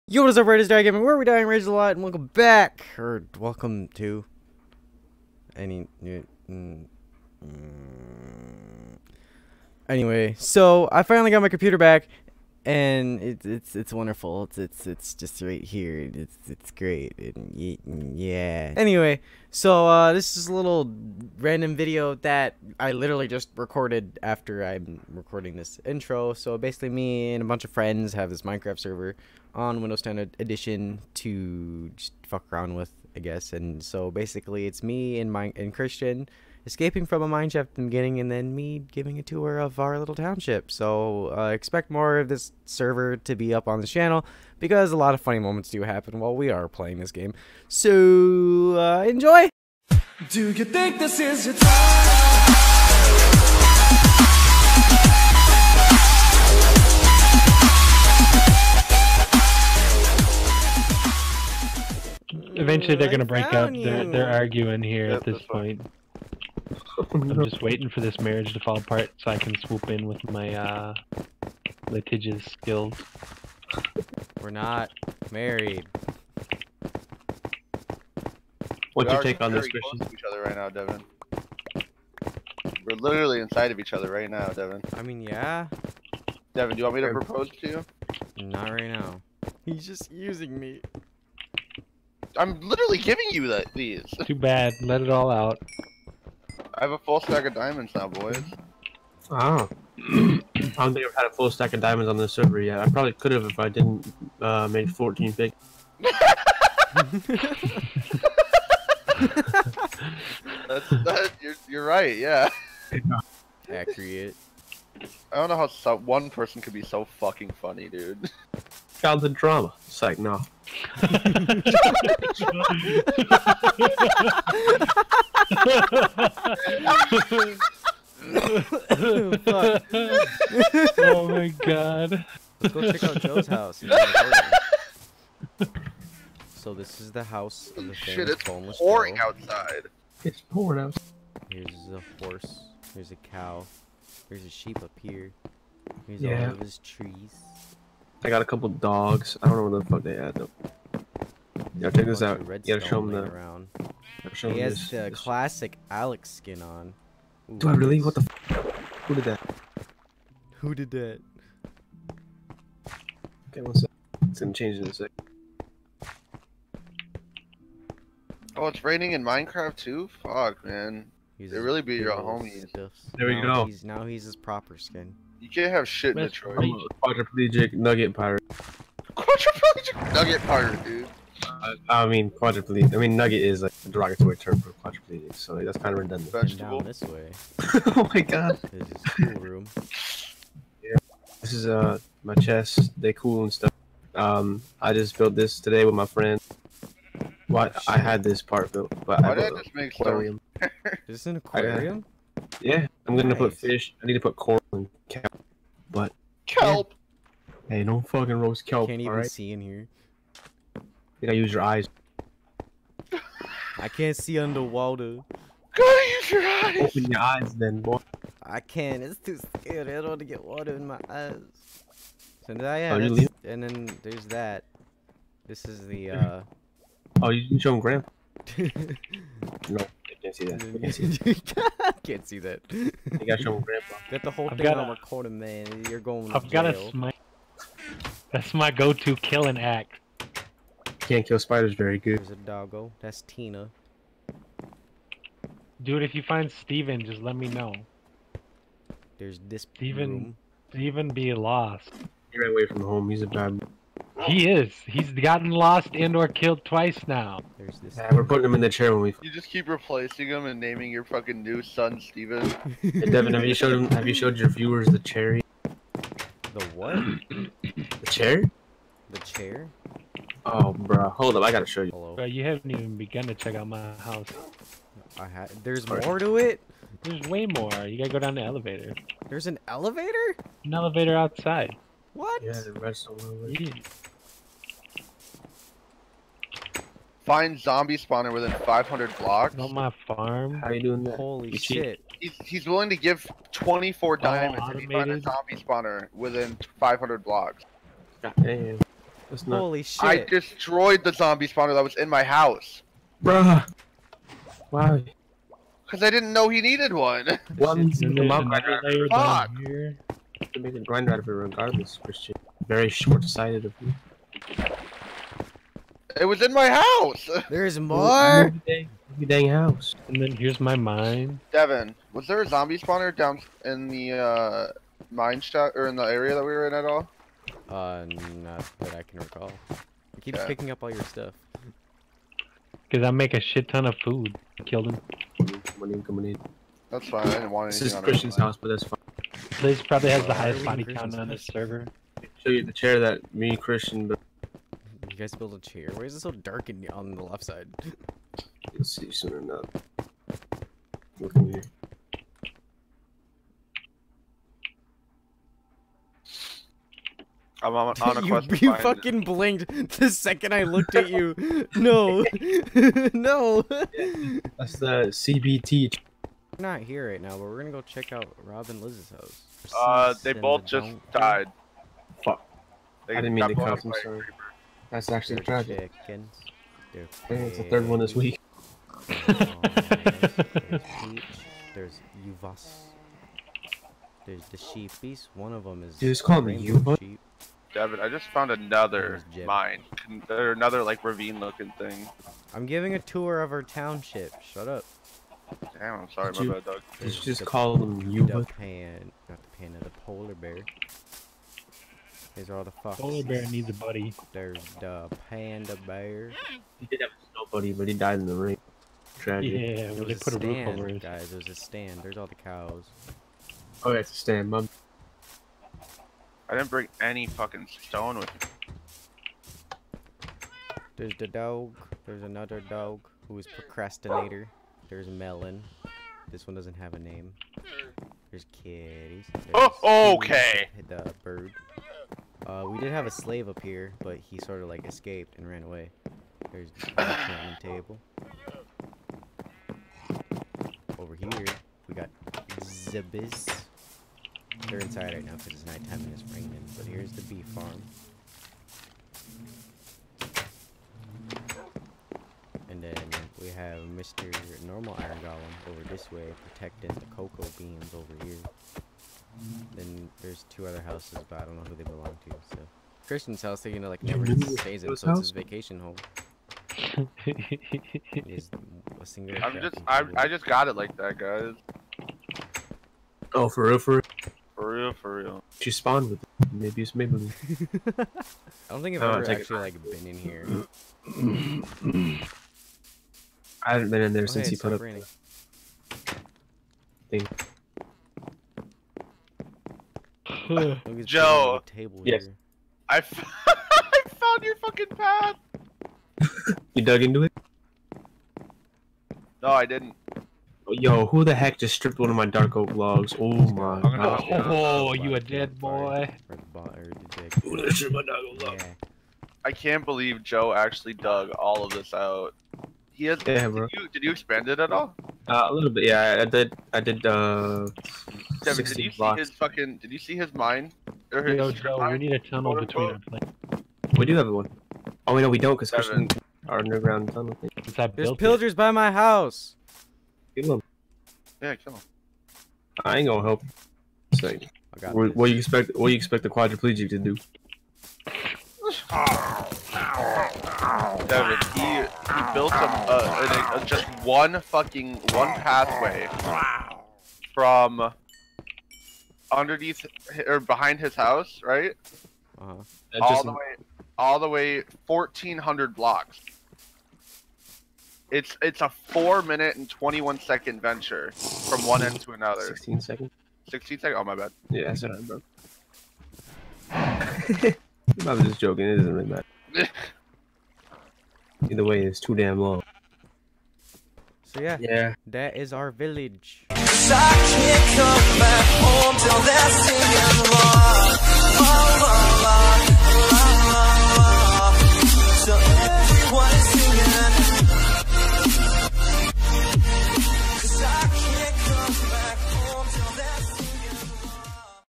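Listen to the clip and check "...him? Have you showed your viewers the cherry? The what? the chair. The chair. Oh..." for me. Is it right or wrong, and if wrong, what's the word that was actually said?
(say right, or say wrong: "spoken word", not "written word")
right.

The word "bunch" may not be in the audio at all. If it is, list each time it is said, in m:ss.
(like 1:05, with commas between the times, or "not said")
0:27.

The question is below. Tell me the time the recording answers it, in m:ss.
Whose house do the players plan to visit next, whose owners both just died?
6:08.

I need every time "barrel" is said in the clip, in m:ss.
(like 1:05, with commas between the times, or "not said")
not said.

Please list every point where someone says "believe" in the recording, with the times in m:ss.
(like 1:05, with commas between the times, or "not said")
8:29.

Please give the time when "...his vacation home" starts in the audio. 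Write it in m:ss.
7:45.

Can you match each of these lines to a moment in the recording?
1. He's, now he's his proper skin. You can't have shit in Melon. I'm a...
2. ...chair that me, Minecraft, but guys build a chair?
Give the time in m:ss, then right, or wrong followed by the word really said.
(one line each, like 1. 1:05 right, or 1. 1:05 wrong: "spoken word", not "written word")
1. 2:53 wrong: "Detroit", not "Melon"
2. 5:42 wrong: "Christian", not "Minecraft".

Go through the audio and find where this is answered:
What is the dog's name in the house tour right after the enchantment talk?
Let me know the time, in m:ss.
4:03.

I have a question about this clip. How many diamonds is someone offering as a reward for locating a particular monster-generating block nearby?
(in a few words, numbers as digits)
24.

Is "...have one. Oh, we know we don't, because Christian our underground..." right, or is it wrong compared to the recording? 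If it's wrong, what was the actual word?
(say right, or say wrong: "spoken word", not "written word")
right.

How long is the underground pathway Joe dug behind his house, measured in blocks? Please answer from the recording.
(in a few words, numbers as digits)
1400 blocks.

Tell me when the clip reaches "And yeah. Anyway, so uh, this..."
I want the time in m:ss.
0:17.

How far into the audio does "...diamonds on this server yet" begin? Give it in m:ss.
1:41.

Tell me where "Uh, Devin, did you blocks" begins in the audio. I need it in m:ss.
8:37.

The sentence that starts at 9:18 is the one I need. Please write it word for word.
It's it's a four minute and twenty one second venture from one end to another.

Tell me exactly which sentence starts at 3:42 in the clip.
So yeah, oh, and then there's that.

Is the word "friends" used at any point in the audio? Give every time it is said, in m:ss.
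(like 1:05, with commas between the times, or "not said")
0:27, 3:16.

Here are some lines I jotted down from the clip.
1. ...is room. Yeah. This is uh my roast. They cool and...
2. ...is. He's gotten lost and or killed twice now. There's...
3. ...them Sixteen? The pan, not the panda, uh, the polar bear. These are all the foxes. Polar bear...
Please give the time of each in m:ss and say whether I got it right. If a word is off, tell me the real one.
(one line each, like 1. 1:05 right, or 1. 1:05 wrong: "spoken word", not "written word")
1. 3:09 wrong: "chest", not "roast"
2. 4:14 right
3. 6:37 wrong: "Yuba", not "Sixteen".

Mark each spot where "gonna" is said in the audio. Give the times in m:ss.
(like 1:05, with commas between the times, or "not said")
2:44, 3:23, 6:07, 8:53.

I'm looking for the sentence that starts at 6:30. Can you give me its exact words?
Or another like ravine looking thing.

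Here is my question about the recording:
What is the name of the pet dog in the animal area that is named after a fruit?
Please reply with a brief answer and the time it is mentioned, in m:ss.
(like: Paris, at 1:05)
Melon, at 7:05.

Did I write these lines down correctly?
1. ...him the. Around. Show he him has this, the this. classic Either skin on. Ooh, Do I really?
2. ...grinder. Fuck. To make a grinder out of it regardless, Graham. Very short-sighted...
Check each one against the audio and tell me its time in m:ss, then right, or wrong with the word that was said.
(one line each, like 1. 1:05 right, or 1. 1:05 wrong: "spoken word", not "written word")
1. 2:32 wrong: "Alex", not "Either"
2. 5:08 wrong: "Christian", not "Graham".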